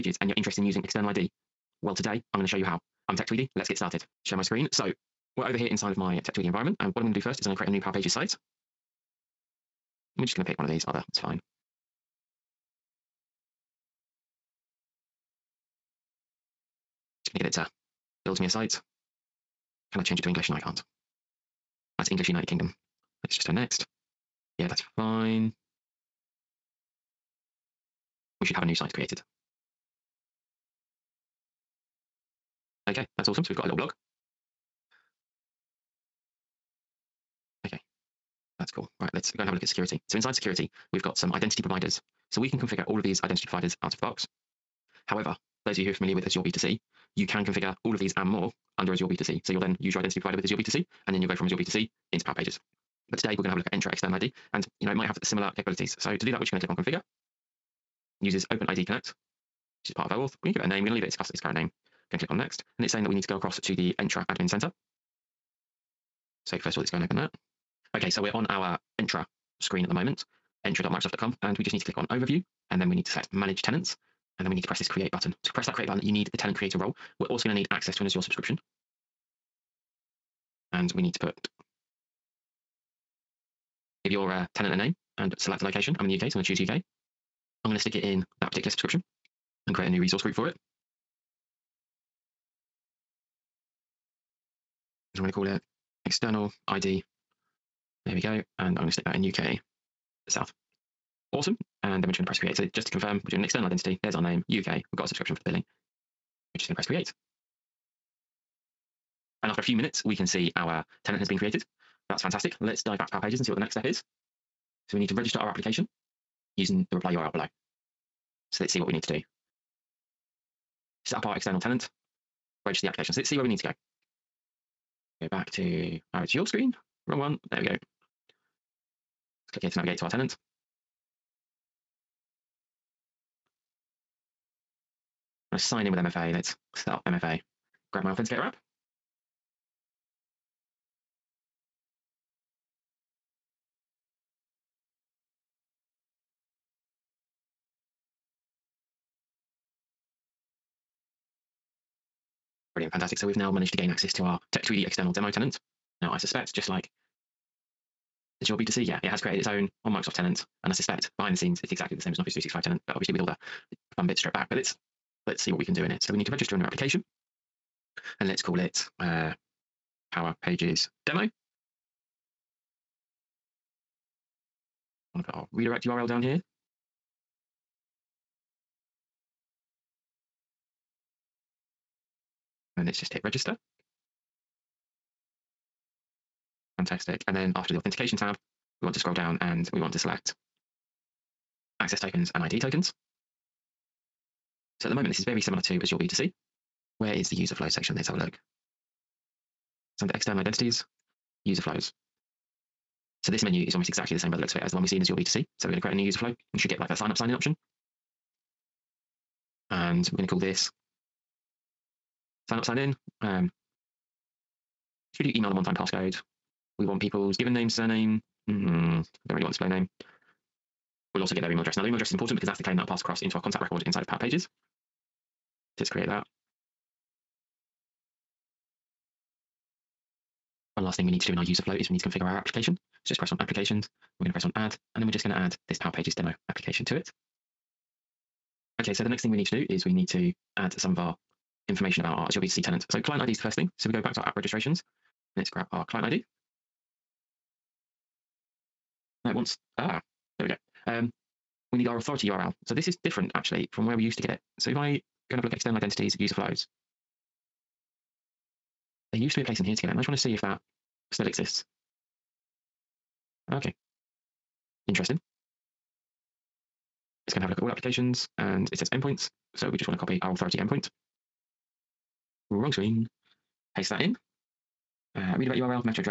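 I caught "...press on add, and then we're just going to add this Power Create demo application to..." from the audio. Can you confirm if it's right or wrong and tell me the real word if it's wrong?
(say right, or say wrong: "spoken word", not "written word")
wrong: "Pages", not "Create".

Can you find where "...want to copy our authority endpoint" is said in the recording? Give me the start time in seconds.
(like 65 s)
269 s.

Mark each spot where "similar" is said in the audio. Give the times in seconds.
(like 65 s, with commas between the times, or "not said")
55 s, 195 s.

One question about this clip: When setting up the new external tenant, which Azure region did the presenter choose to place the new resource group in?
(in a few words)
UK South.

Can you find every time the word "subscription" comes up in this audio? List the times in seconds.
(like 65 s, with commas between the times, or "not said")
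78 s, 88 s, 105 s.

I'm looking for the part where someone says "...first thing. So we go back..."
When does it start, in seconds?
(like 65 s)
243 s.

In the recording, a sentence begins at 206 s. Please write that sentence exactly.
and should get like a sign up, sign in option.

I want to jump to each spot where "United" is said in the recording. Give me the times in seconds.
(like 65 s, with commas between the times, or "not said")
22 s.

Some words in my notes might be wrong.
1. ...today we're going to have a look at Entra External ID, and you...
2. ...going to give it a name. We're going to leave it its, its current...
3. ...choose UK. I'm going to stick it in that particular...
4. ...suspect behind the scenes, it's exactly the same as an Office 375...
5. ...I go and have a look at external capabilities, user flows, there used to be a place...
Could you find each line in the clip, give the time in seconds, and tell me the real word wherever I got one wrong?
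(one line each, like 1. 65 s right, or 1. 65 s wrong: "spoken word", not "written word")
1. 53 s right
2. 60 s right
3. 86 s right
4. 160 s wrong: "365", not "375"
5. 254 s wrong: "identities", not "capabilities".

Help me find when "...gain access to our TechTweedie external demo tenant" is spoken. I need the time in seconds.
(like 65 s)
153 s.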